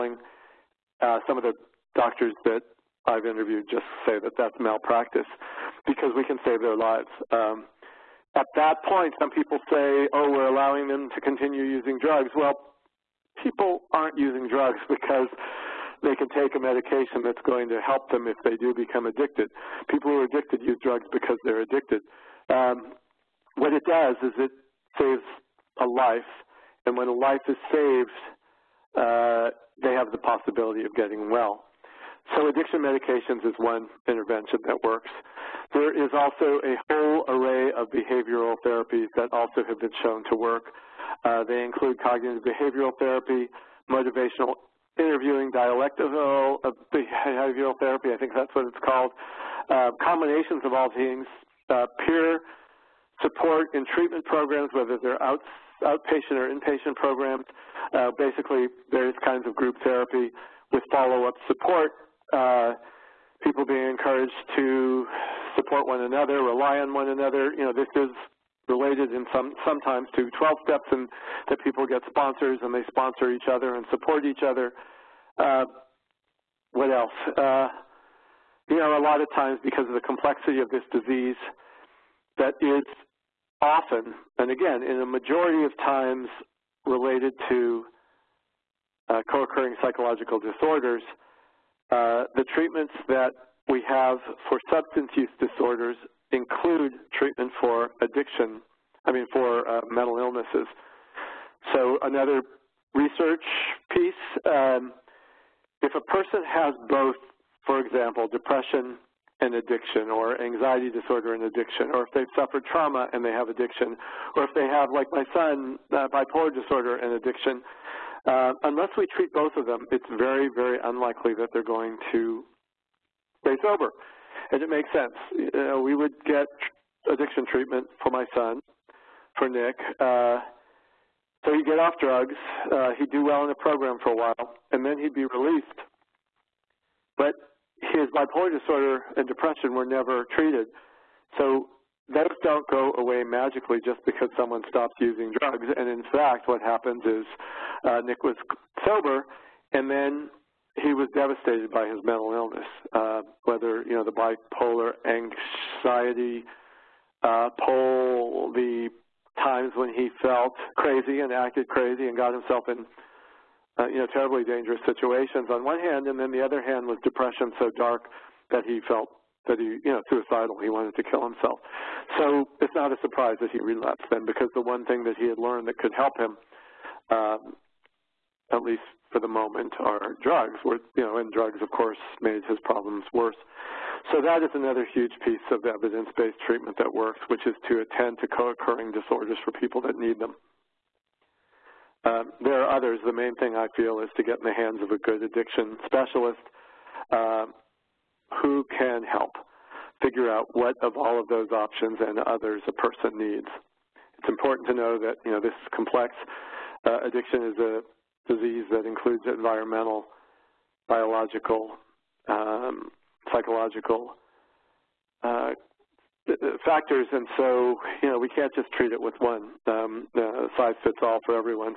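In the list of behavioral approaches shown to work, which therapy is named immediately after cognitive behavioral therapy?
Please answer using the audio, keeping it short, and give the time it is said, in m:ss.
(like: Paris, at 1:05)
Motivational interviewing, at 0:43.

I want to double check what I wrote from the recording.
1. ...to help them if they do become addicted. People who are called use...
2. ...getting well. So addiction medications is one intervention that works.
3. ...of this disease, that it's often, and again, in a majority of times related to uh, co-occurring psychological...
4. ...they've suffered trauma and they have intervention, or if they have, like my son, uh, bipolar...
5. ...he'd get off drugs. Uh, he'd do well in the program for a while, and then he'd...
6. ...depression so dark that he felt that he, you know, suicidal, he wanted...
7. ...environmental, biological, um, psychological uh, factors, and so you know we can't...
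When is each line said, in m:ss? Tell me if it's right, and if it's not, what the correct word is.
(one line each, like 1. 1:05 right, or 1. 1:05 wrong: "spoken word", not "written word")
1. 0:17 wrong: "addicted", not "called"
2. 0:30 right
3. 1:20 right
4. 1:52 wrong: "addiction", not "intervention"
5. 2:11 right
6. 2:47 right
7. 3:29 right.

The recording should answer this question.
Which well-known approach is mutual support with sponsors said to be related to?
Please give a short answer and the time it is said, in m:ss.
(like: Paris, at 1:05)
12 steps, at 1:10.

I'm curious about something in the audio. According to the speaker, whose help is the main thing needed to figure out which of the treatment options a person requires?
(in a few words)
A good addiction specialist.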